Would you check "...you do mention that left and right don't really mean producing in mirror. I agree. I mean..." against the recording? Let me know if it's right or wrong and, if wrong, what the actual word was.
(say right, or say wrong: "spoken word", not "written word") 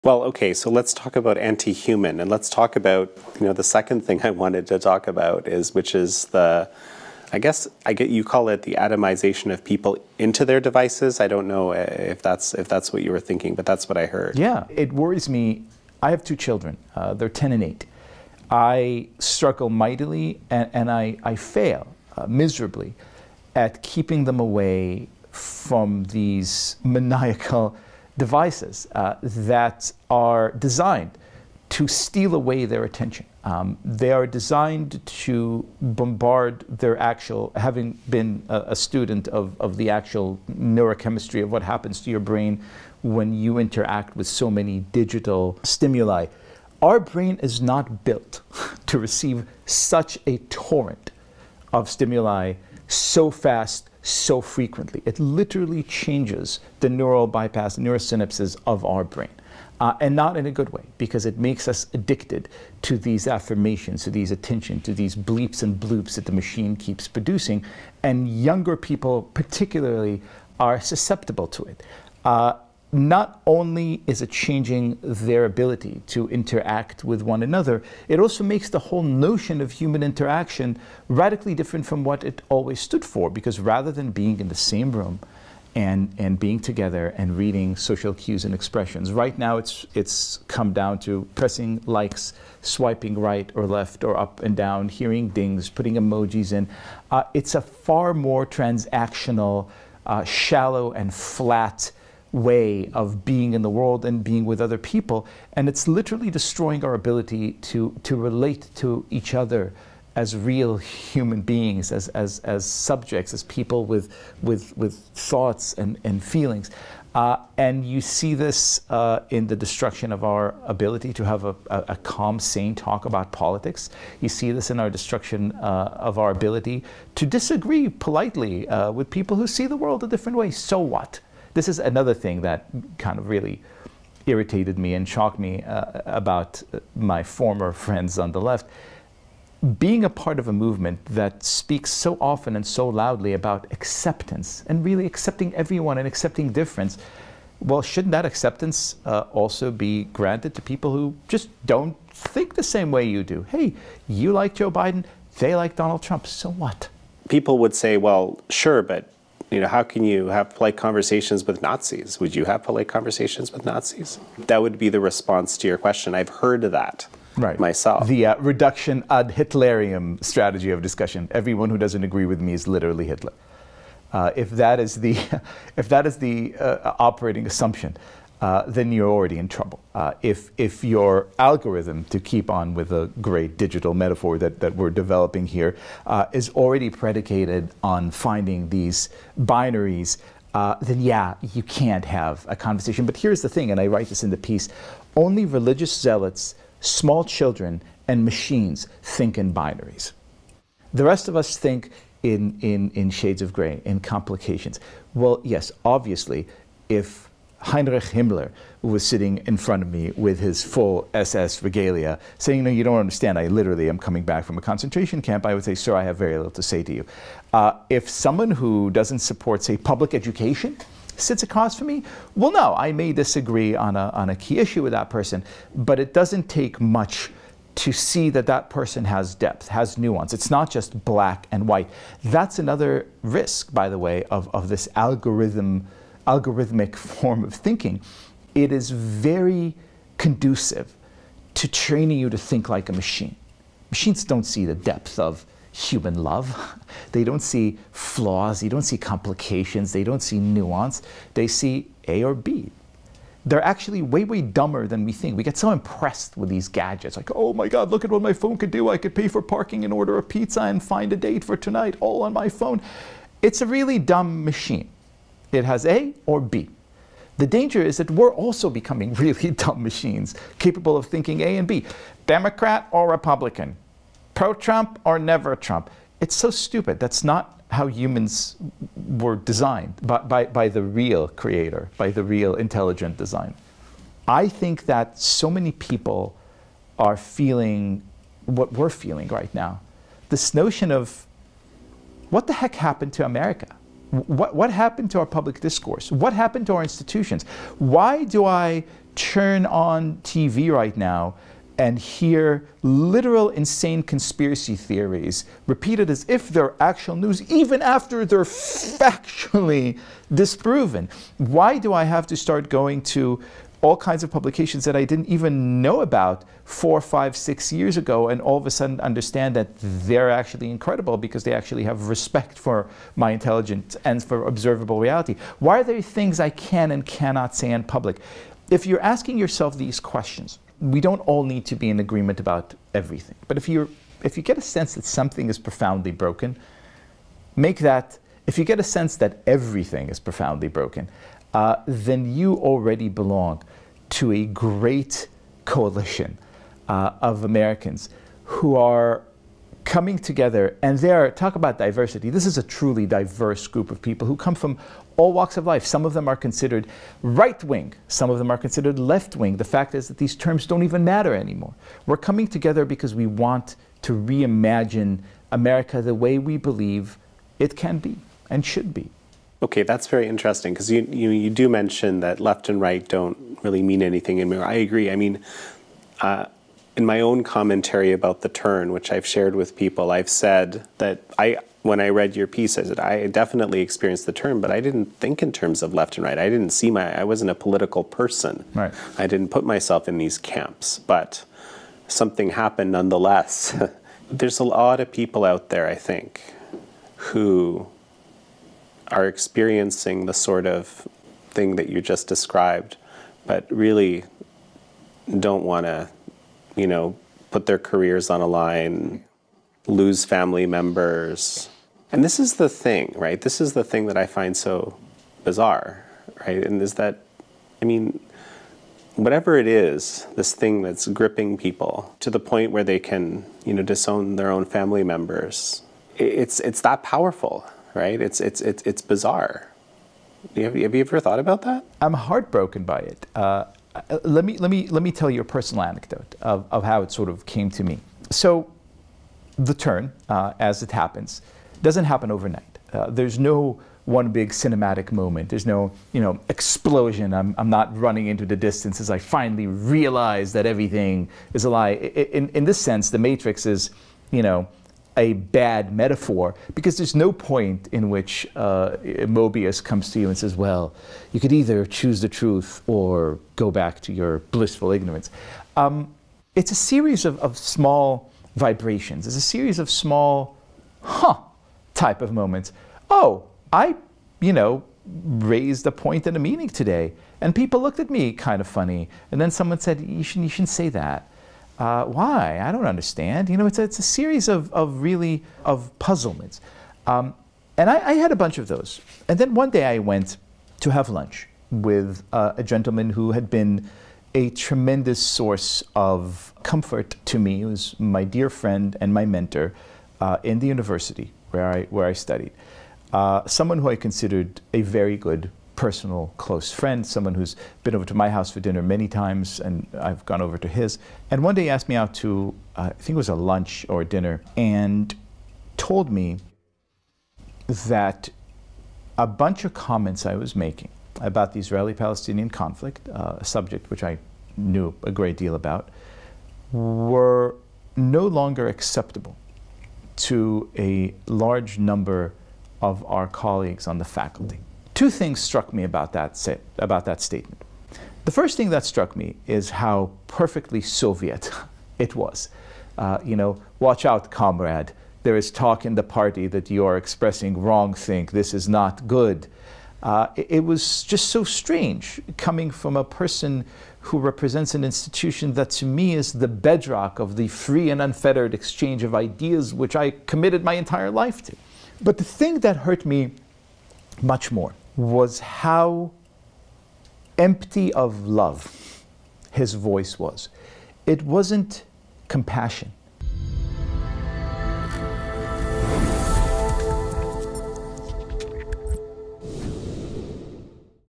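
wrong: "anything", not "producing".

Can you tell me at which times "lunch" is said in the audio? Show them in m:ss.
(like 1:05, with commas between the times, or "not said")
8:11, 8:33.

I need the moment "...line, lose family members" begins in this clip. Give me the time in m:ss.
6:48.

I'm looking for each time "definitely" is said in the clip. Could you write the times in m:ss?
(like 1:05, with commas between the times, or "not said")
6:23.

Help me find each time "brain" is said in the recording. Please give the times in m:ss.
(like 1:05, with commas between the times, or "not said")
0:42, 0:46, 0:59.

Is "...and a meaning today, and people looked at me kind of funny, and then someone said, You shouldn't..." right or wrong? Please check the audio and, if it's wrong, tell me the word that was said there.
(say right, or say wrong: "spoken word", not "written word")
right.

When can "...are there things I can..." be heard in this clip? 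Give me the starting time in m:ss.
5:25.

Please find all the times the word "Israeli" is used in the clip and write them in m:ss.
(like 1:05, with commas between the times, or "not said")
8:41.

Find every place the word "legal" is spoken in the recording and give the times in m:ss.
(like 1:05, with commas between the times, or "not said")
not said.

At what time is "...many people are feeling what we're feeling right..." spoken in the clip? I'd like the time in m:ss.
4:45.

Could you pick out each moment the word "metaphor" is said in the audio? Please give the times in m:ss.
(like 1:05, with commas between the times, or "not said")
3:03, 7:35.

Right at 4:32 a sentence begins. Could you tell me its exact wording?
Democrat or Republican, pro Trump or never Trump.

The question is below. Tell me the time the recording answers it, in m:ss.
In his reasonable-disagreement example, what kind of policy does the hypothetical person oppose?
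3:39.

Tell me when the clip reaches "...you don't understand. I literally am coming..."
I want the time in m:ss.
3:32.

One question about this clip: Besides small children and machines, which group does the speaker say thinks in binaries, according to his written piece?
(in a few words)
religious zealots.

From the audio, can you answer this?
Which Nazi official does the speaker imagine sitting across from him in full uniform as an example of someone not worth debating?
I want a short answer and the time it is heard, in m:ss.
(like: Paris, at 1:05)
Heinrich Himmler, at 3:27.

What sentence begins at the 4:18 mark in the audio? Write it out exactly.
I could pay for parking and order a pizza and find a date for tonight all on my phone.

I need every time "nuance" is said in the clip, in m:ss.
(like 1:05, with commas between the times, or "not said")
3:49, 4:10.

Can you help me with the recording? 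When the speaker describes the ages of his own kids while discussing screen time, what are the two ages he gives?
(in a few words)
10 and 8.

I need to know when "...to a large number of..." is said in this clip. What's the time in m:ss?
8:50.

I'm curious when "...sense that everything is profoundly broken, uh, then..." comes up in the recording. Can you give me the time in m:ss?
5:38.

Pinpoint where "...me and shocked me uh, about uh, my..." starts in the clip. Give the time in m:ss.
2:14.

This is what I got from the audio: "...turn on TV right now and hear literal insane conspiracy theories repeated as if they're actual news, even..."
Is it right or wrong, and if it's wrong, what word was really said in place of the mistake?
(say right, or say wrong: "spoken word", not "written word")
right.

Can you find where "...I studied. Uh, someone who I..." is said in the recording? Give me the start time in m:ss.
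8:22.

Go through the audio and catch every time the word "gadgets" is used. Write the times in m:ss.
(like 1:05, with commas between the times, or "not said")
4:16.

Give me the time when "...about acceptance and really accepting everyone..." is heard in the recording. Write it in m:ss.
2:23.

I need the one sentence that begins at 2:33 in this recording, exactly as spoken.
Hey, you like Joe Biden, they like Donald Trump, so what?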